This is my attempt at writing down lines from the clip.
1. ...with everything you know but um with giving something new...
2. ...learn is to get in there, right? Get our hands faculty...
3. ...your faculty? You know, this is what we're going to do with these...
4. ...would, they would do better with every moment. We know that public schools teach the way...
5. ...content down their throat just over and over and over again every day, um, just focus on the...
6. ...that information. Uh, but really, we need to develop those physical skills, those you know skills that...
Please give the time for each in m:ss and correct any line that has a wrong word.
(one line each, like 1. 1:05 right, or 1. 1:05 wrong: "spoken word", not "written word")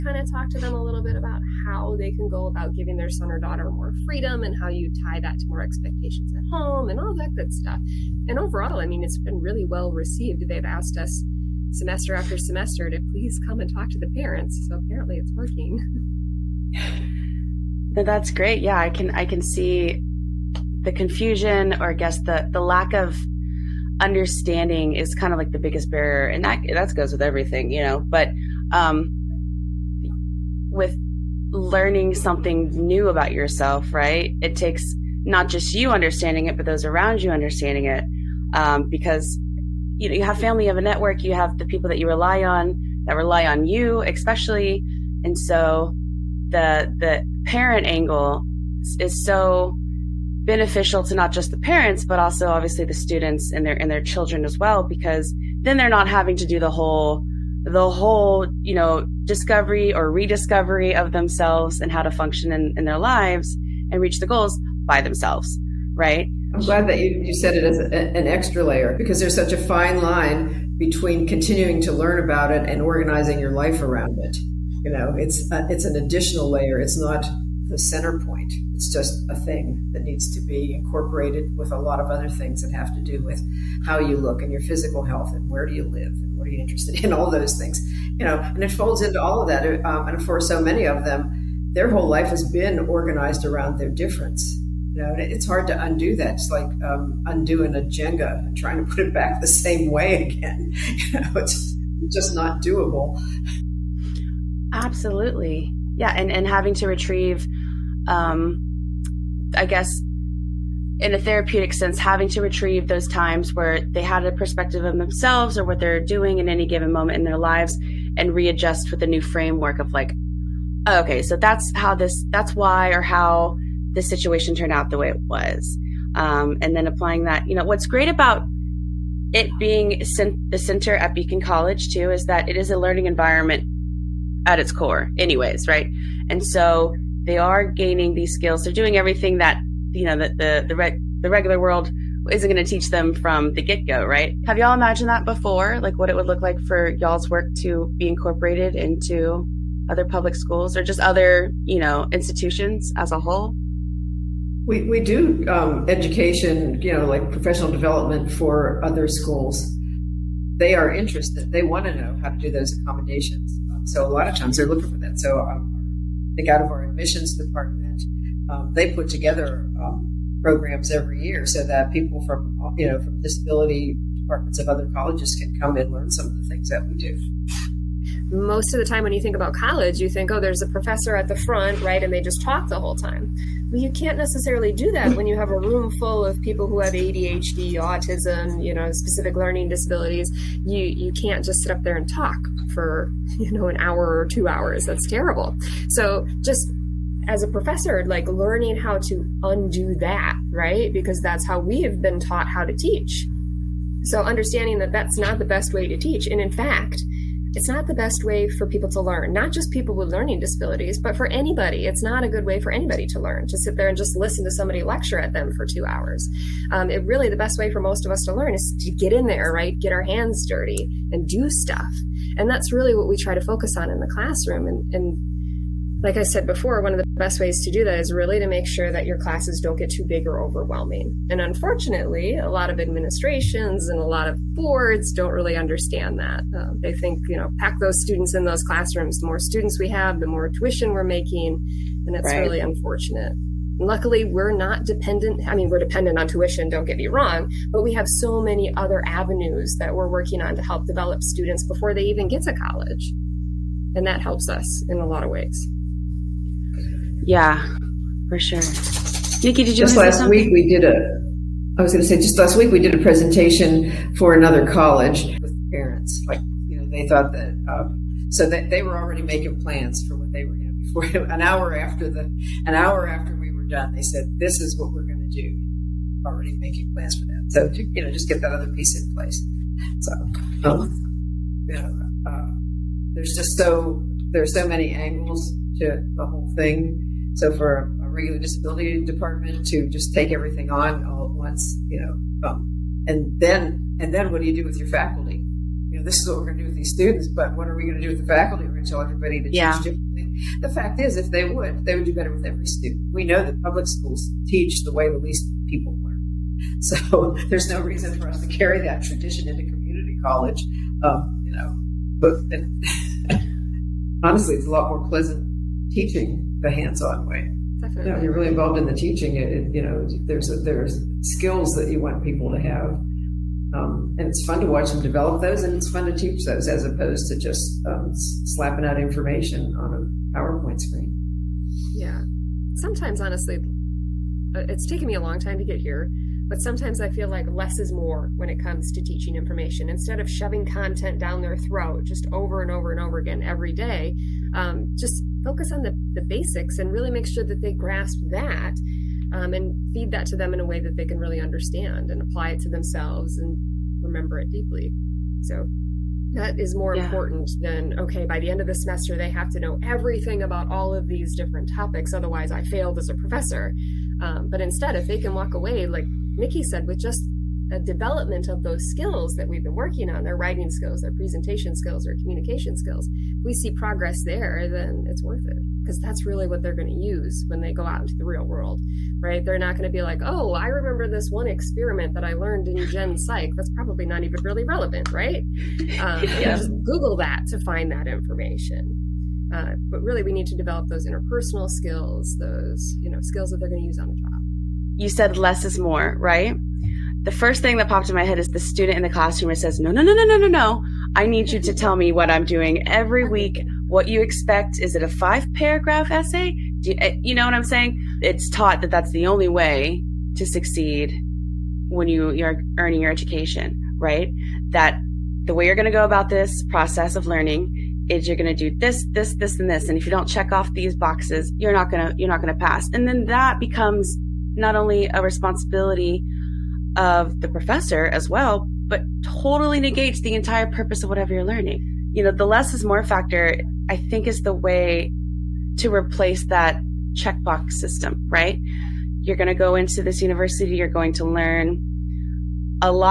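1. 0:27 wrong: "learning", not "giving"
2. 3:38 wrong: "dirty", not "faculty"
3. 4:54 right
4. 5:01 wrong: "student", not "moment"
5. 5:40 right
6. 6:27 wrong: "interpersonal", not "physical".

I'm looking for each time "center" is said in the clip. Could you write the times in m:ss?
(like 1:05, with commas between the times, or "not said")
1:17, 2:10.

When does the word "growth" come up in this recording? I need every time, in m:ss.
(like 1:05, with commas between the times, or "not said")
not said.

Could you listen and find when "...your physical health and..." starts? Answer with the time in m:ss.
1:24.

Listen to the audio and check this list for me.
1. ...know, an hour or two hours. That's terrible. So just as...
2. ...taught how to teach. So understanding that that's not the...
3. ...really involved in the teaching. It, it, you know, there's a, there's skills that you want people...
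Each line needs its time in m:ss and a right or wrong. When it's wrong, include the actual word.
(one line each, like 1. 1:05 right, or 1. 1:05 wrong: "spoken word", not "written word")
1. 3:13 right
2. 3:22 right
3. 5:18 right.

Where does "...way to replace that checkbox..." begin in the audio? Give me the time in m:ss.
7:14.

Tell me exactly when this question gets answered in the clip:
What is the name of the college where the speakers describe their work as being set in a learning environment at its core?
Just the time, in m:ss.
2:11.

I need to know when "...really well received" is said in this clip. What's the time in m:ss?
0:09.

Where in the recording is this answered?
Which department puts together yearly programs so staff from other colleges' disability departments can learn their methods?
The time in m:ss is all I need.
2:46.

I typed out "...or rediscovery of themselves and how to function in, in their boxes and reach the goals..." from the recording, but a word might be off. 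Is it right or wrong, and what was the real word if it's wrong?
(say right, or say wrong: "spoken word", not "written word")
wrong: "lives", not "boxes".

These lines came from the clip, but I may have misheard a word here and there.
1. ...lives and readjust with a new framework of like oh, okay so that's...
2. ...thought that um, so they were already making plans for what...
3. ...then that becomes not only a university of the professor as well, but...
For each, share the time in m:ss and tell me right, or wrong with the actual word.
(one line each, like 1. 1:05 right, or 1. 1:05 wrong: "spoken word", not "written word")
1. 1:57 right
2. 4:27 right
3. 7:03 wrong: "responsibility", not "university".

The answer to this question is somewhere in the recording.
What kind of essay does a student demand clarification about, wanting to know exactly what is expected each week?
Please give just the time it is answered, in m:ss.
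6:45.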